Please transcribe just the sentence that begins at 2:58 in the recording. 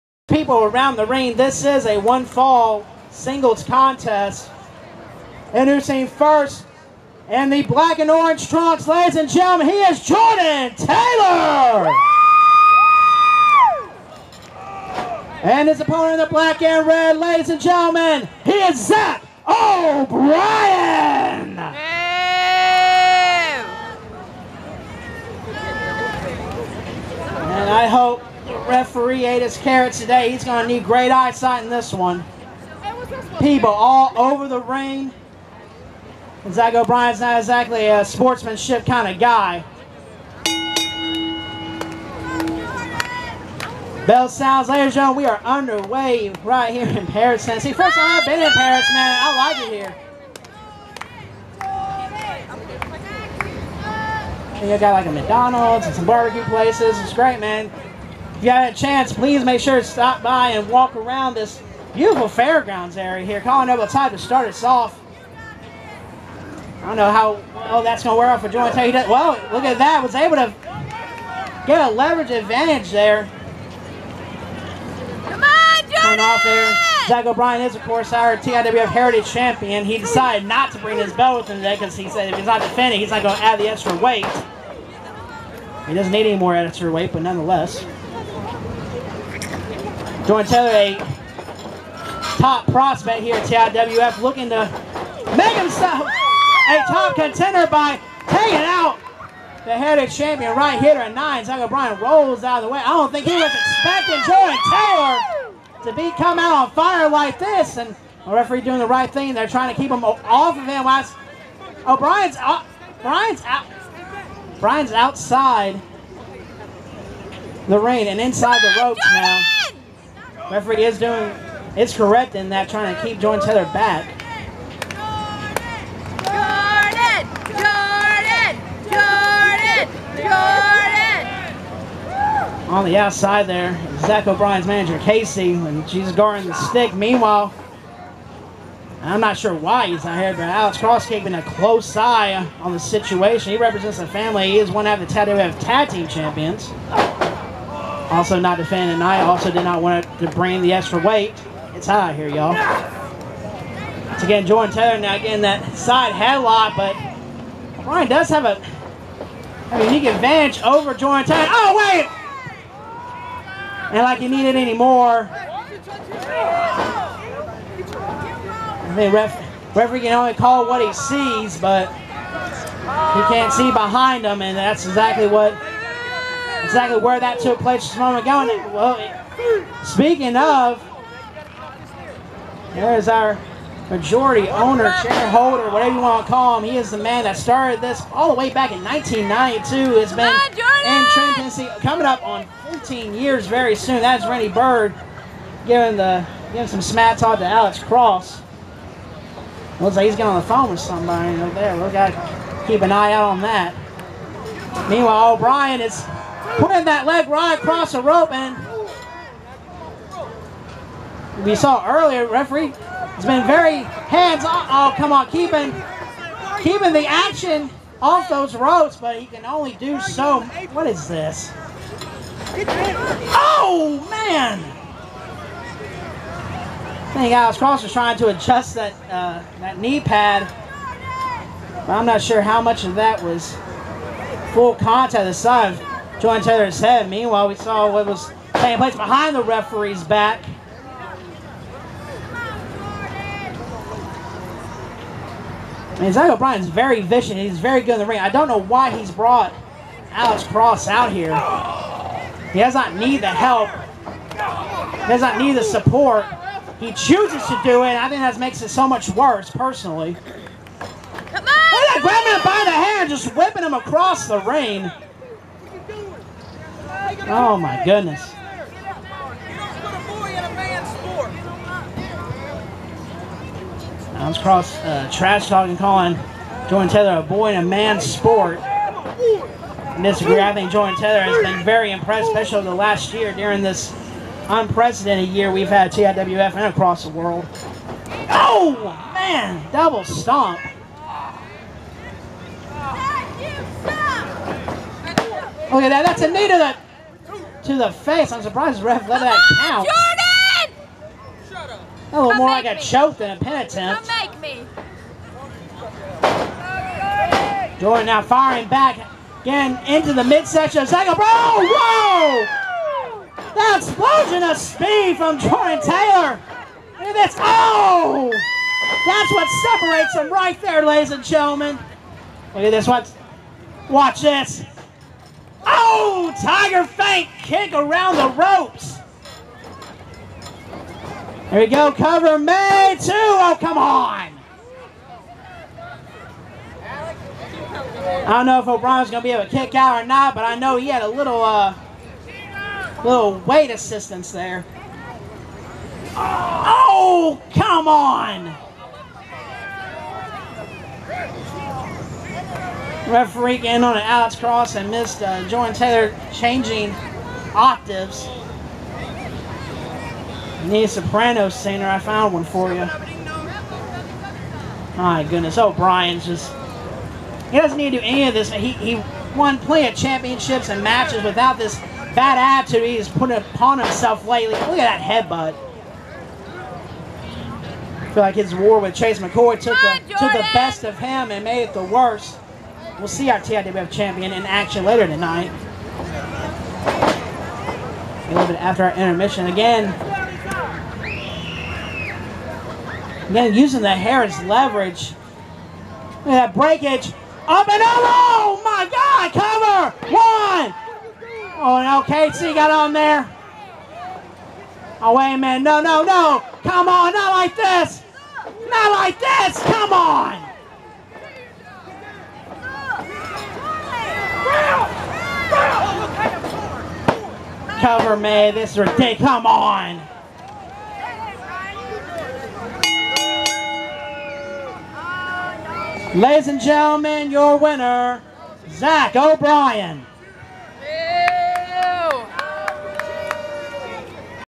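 And well, speaking of, there is our majority owner, shareholder, whatever you want to call him.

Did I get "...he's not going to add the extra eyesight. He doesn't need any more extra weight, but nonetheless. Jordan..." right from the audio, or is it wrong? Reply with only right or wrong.
wrong.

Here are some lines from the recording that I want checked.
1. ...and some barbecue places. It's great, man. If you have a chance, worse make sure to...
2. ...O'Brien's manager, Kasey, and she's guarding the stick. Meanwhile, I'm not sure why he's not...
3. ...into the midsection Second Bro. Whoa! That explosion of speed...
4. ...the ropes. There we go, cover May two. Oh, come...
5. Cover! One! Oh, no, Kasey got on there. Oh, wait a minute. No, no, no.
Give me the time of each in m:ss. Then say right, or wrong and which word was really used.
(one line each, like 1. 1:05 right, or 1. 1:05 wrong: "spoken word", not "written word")
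1. 0:55 wrong: "please", not "worse"
2. 2:14 right
3. 5:09 right
4. 5:28 right
5. 6:39 right.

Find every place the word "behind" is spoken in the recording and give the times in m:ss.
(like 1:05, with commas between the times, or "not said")
2:53, 3:58.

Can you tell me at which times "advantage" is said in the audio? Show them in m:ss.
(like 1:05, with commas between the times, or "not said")
1:12, 2:40.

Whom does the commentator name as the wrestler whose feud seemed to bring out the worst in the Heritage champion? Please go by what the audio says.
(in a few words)
Chase McCoy.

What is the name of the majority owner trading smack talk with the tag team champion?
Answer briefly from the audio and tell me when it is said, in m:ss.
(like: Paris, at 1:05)
Randy Bird, at 3:14.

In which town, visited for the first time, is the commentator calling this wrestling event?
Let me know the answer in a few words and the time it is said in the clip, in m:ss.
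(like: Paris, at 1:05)
Paris, Tennessee, at 0:47.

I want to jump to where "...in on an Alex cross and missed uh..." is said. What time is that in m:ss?
5:53.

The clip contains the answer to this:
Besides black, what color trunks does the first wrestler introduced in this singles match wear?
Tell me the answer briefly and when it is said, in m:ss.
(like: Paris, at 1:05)
Orange, at 0:07.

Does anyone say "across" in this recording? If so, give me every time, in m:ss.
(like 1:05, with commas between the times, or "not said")
3:27, 4:23, 4:46.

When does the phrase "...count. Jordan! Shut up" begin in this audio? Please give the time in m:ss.
4:59.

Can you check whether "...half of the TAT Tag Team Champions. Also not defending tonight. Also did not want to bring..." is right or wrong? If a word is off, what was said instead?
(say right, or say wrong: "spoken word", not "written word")
right.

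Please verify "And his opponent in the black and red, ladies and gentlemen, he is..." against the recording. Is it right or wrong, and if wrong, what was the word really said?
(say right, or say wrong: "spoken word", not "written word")
right.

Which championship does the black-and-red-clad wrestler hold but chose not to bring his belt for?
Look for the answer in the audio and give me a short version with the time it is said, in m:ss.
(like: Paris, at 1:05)
TIWF Heritage Champion, at 1:18.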